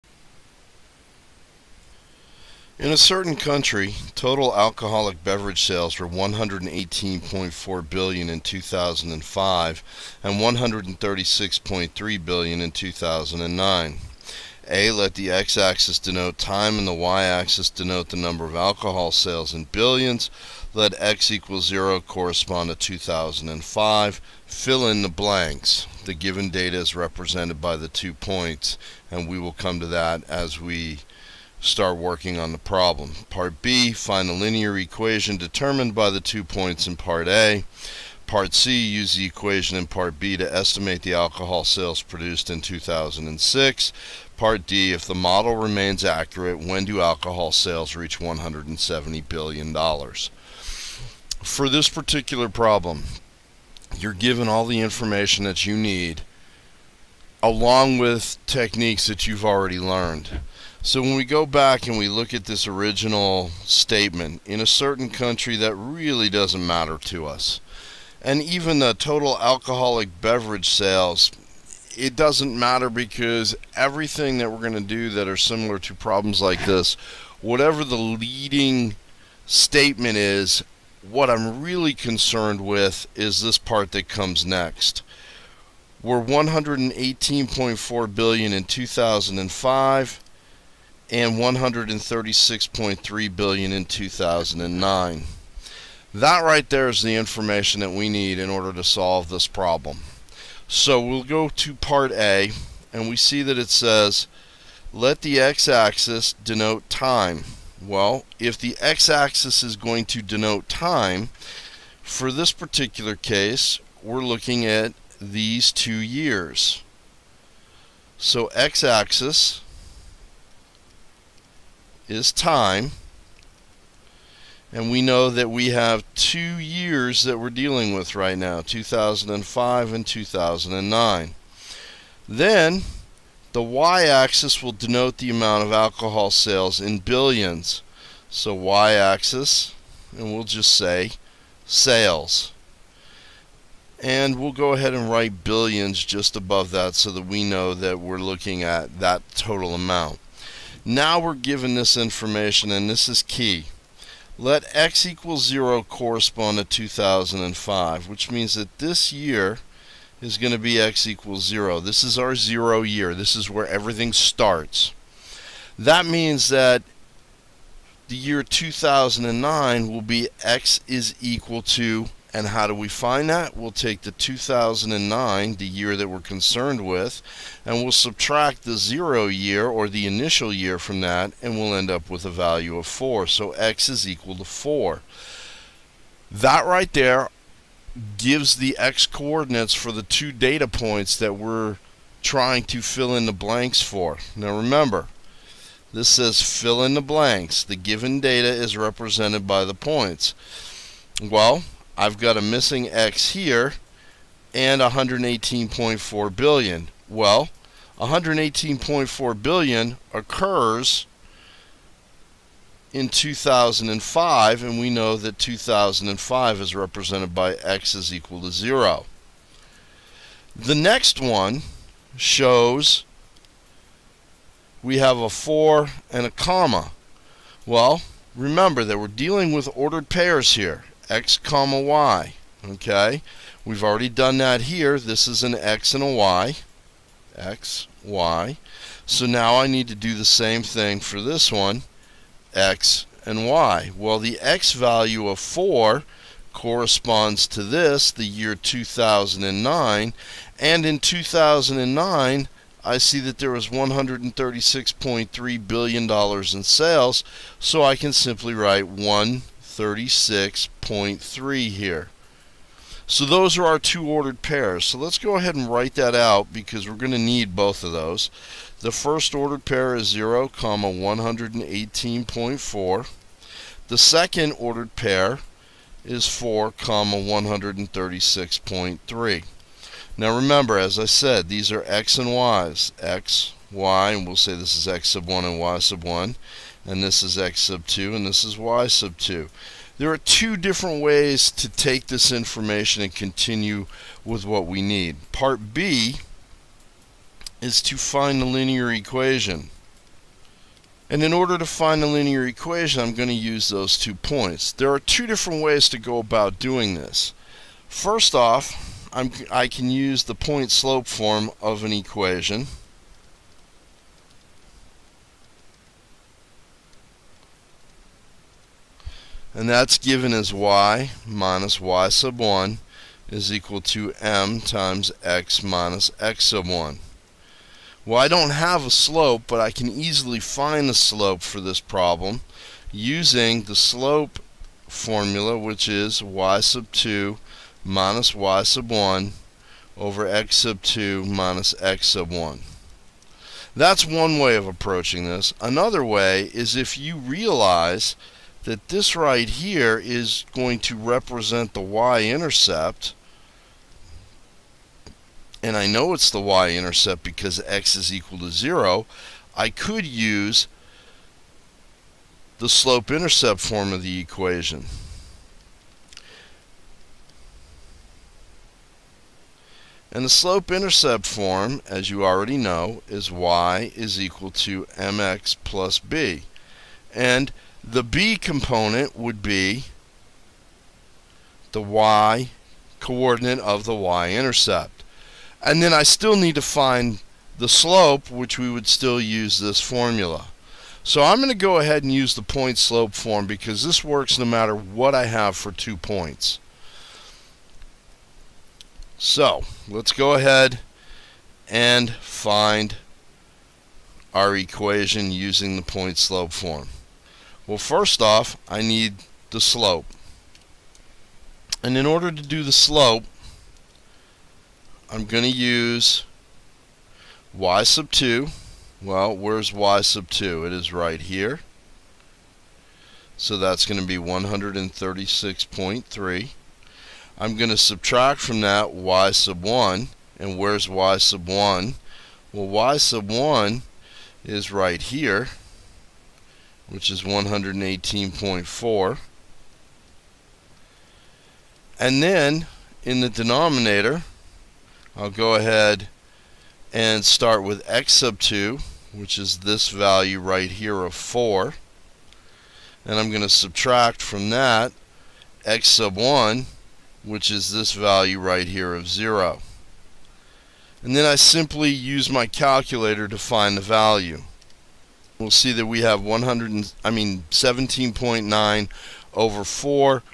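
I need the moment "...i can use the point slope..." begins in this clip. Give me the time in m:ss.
5:09.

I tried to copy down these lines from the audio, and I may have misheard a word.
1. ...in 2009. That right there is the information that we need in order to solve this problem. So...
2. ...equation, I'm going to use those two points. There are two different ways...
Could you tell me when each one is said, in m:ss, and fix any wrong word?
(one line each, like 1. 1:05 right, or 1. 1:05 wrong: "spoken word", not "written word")
1. 1:33 right
2. 5:02 right.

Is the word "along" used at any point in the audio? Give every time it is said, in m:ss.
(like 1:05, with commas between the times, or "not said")
0:57.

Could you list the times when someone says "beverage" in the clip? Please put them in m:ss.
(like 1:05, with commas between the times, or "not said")
0:05, 1:10.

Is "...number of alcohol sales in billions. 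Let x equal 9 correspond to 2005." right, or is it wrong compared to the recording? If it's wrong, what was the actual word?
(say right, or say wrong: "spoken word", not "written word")
wrong: "0", not "9".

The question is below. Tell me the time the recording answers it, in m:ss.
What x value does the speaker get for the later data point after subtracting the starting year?
3:02.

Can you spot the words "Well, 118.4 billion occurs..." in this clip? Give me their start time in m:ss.
3:27.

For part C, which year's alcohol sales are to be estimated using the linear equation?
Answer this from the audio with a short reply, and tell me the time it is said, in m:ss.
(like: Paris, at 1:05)
2006, at 0:42.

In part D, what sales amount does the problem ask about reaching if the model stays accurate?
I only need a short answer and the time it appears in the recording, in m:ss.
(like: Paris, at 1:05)
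$170 billion, at 0:48.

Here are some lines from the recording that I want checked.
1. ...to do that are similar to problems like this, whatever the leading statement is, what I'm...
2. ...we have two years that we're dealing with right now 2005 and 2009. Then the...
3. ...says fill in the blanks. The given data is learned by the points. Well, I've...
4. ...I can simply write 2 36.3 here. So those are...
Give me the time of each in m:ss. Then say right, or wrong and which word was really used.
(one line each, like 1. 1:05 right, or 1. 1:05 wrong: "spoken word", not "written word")
1. 1:14 right
2. 2:05 right
3. 3:16 wrong: "represented", not "learned"
4. 4:17 wrong: "1", not "2".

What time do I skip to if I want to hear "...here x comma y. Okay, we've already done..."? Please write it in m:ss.
3:50.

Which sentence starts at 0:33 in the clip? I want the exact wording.
Part B, find a linear equation determined by the two points in part A.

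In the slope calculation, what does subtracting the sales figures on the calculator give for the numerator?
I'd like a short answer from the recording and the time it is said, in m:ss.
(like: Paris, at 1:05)
17.9, at 7:47.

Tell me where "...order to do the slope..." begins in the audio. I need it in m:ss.
6:52.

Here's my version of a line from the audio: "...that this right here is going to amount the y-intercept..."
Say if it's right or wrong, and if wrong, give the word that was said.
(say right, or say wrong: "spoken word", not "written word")
wrong: "represent", not "amount".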